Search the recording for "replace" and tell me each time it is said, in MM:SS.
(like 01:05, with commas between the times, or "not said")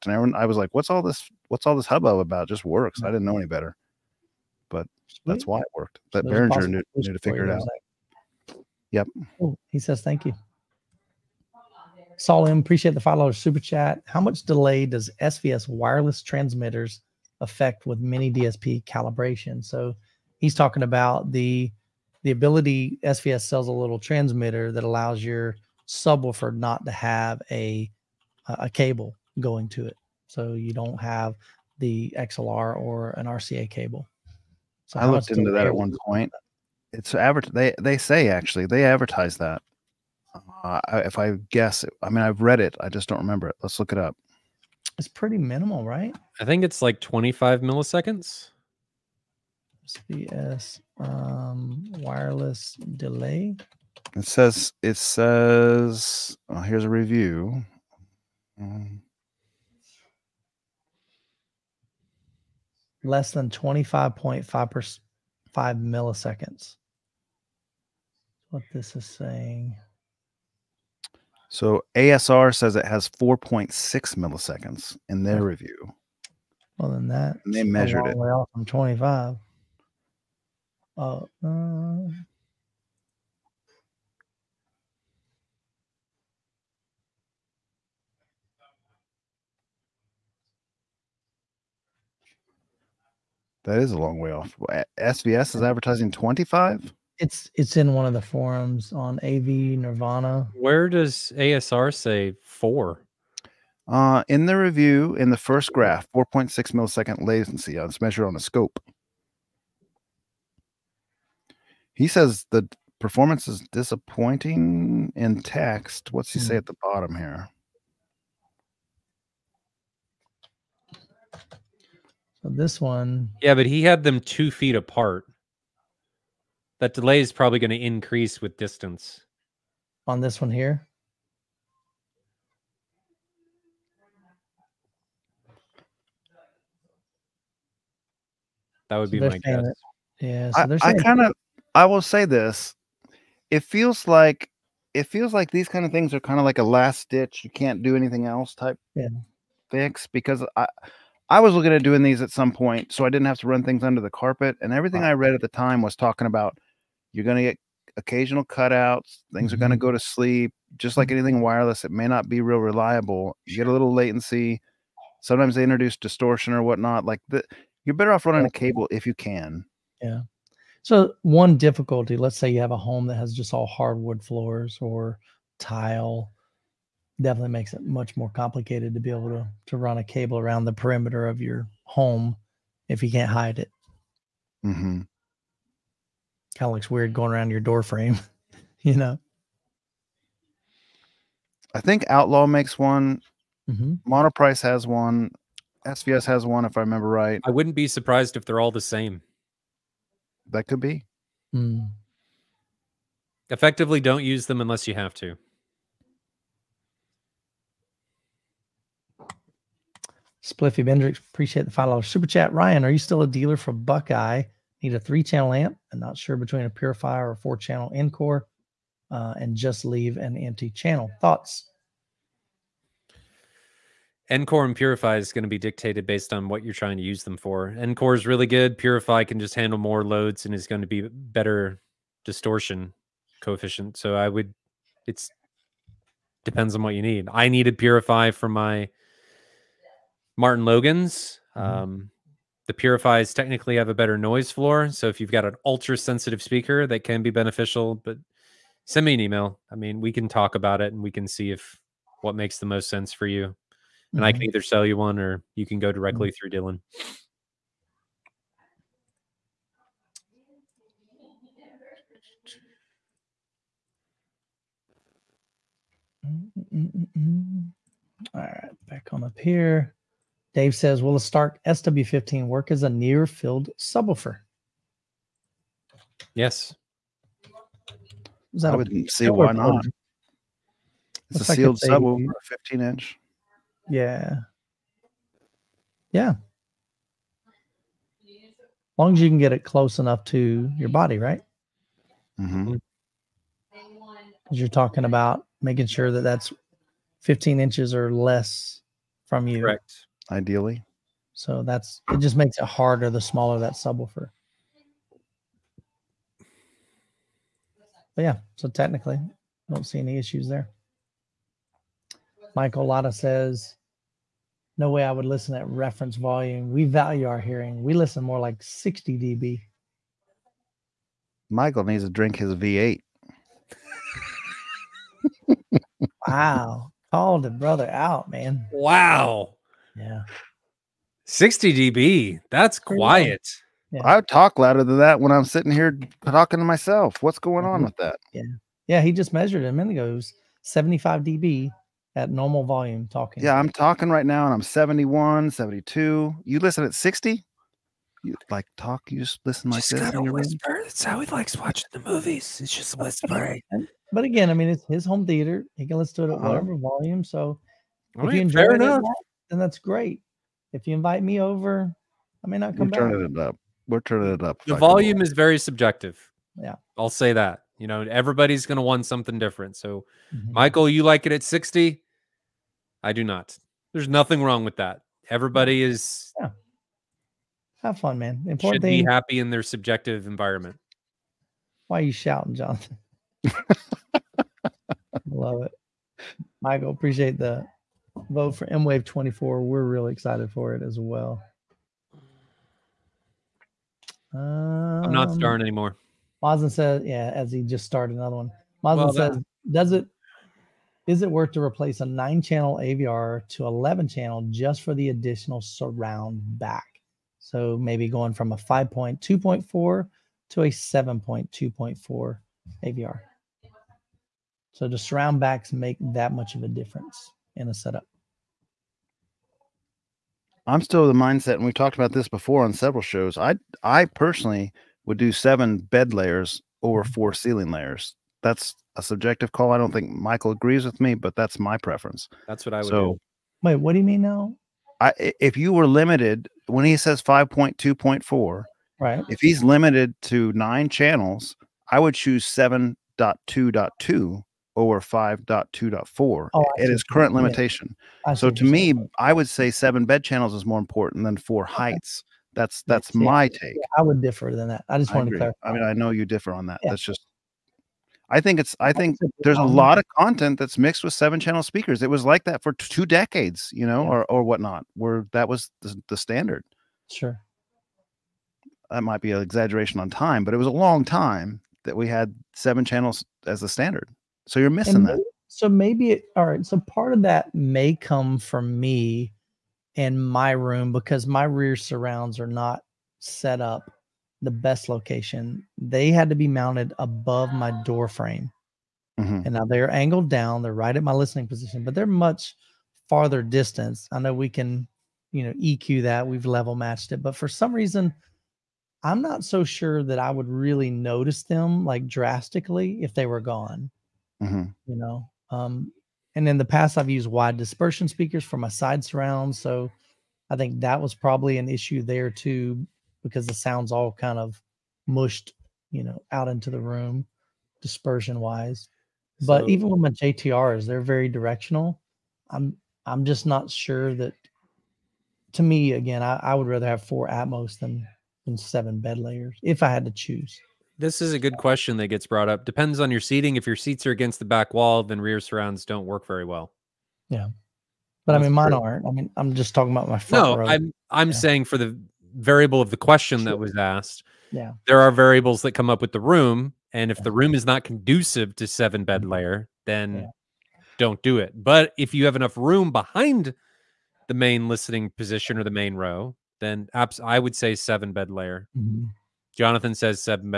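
06:41.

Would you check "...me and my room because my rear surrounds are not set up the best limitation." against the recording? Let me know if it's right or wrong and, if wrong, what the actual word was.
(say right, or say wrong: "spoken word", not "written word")
wrong: "location", not "limitation".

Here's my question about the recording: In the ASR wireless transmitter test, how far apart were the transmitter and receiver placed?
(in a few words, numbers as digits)
two feet.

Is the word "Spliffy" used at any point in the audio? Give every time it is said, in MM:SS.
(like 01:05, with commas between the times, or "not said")
03:30.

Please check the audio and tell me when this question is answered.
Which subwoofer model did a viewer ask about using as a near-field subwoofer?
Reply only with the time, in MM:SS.
04:31.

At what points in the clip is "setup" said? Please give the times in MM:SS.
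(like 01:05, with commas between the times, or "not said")
06:57.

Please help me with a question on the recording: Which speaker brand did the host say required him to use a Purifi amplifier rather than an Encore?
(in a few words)
Martin Logan.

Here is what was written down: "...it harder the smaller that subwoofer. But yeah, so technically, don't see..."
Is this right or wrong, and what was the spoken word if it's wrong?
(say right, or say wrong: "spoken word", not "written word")
right.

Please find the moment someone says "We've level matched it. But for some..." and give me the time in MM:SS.
08:16.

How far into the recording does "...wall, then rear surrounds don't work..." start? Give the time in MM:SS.
08:54.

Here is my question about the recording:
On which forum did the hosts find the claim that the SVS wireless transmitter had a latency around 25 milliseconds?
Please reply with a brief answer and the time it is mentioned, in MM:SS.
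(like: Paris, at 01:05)
AV Nirvana, at 01:39.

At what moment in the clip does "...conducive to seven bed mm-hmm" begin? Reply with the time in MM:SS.
09:07.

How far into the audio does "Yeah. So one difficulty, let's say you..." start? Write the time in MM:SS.
02:50.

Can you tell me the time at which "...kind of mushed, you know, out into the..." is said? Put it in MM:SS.
08:34.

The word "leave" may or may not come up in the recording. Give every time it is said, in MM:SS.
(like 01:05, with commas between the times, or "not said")
03:39.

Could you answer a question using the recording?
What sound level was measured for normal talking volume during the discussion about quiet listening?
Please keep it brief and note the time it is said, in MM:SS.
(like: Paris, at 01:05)
75 dB, at 05:40.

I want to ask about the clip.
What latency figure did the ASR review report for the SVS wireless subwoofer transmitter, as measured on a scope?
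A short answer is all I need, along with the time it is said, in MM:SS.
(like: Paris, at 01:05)
4.6 milliseconds, at 01:13.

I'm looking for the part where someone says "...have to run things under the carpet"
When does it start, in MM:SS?
02:33.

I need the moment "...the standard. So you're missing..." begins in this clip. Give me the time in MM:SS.
07:53.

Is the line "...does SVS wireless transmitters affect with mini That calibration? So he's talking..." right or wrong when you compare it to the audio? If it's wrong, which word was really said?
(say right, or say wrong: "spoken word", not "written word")
wrong: "DSP", not "That".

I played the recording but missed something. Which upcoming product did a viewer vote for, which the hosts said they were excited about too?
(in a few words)
M Wave 24.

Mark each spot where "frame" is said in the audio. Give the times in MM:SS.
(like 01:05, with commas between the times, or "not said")
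03:07, 08:08.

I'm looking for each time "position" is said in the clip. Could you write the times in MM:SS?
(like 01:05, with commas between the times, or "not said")
08:11, 09:15.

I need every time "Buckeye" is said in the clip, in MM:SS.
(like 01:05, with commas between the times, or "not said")
03:33.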